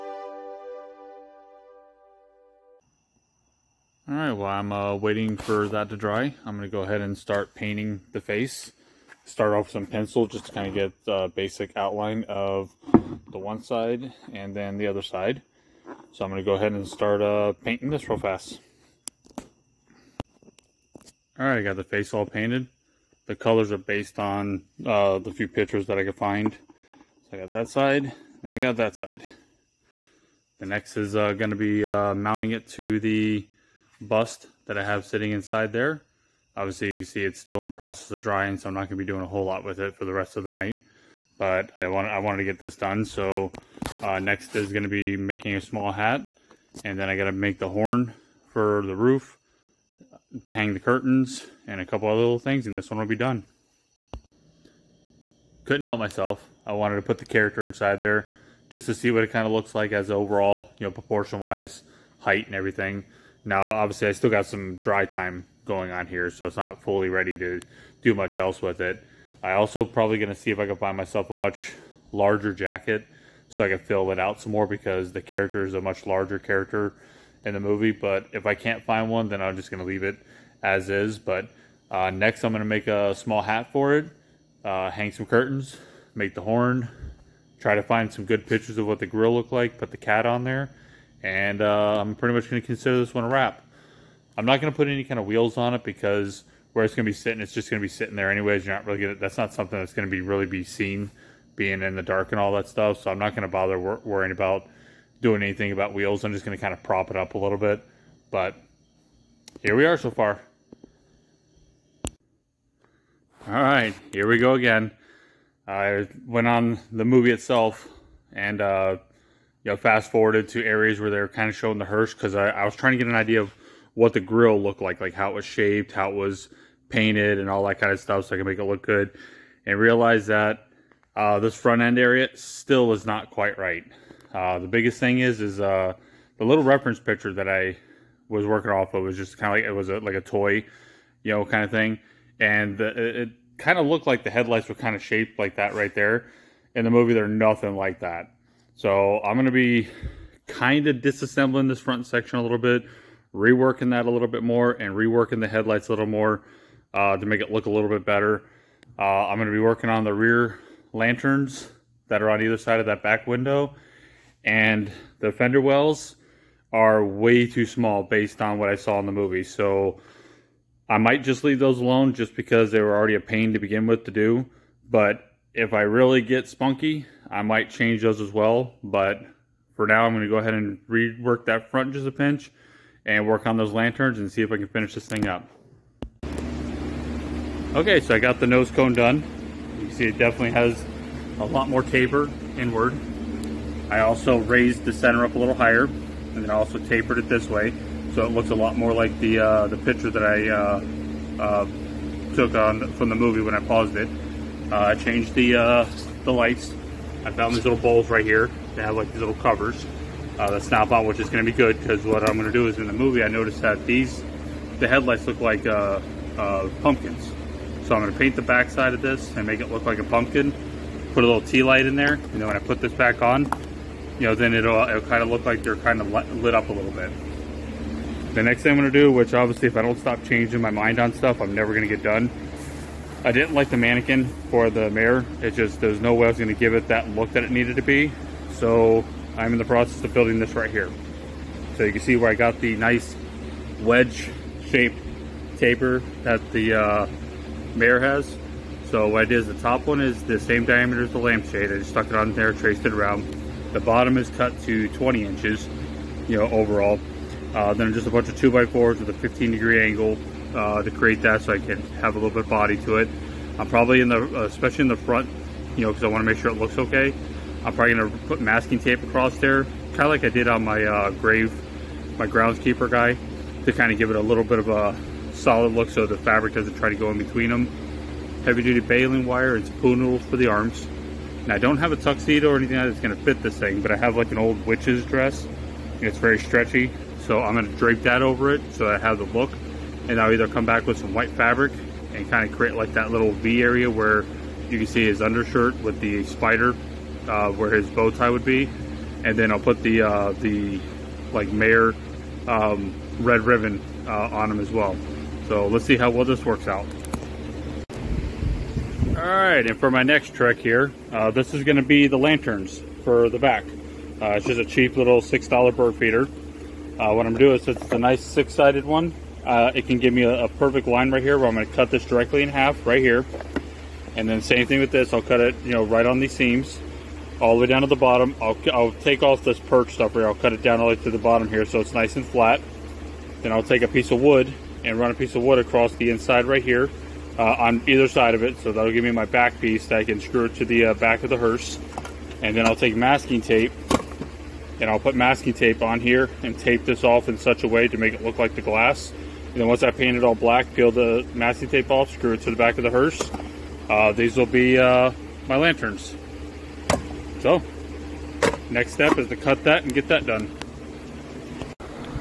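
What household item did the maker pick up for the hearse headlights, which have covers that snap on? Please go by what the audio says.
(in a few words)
Little bowls.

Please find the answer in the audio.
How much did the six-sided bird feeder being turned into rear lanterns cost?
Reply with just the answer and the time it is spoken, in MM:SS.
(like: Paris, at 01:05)
$6, at 05:15.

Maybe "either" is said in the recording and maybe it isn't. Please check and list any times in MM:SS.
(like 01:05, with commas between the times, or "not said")
02:42, 04:50, 05:37.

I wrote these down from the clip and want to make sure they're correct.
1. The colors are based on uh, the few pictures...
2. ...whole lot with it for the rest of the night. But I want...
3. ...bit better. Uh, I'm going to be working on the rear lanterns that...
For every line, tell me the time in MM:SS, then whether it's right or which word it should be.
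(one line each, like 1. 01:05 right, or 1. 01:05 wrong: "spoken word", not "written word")
1. 00:23 right
2. 00:39 right
3. 02:37 right.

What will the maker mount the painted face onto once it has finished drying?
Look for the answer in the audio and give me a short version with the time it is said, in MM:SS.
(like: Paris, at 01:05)
The bust, at 00:32.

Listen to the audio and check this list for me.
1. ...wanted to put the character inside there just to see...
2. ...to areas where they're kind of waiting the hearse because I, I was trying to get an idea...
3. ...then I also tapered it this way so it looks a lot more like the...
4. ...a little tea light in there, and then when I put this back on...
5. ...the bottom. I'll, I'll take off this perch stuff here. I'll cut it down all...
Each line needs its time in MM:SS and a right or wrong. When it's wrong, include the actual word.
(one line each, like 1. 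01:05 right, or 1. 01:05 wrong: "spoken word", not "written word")
1. 00:56 right
2. 02:00 wrong: "showing", not "waiting"
3. 03:16 right
4. 03:41 right
5. 05:27 right.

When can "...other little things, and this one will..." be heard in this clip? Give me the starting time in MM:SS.
00:52.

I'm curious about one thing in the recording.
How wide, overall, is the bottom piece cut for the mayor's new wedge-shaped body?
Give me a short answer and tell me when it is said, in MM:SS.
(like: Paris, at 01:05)
20 inches, at 04:14.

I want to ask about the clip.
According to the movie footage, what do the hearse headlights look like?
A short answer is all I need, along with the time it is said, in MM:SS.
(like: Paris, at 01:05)
Pumpkins, at 03:36.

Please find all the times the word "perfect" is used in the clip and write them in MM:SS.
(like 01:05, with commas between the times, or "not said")
05:20.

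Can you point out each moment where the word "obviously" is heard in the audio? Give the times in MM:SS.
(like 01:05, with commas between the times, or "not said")
00:36, 01:03, 03:49.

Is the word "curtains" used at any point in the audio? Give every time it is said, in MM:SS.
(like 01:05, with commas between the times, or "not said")
00:50, 01:25.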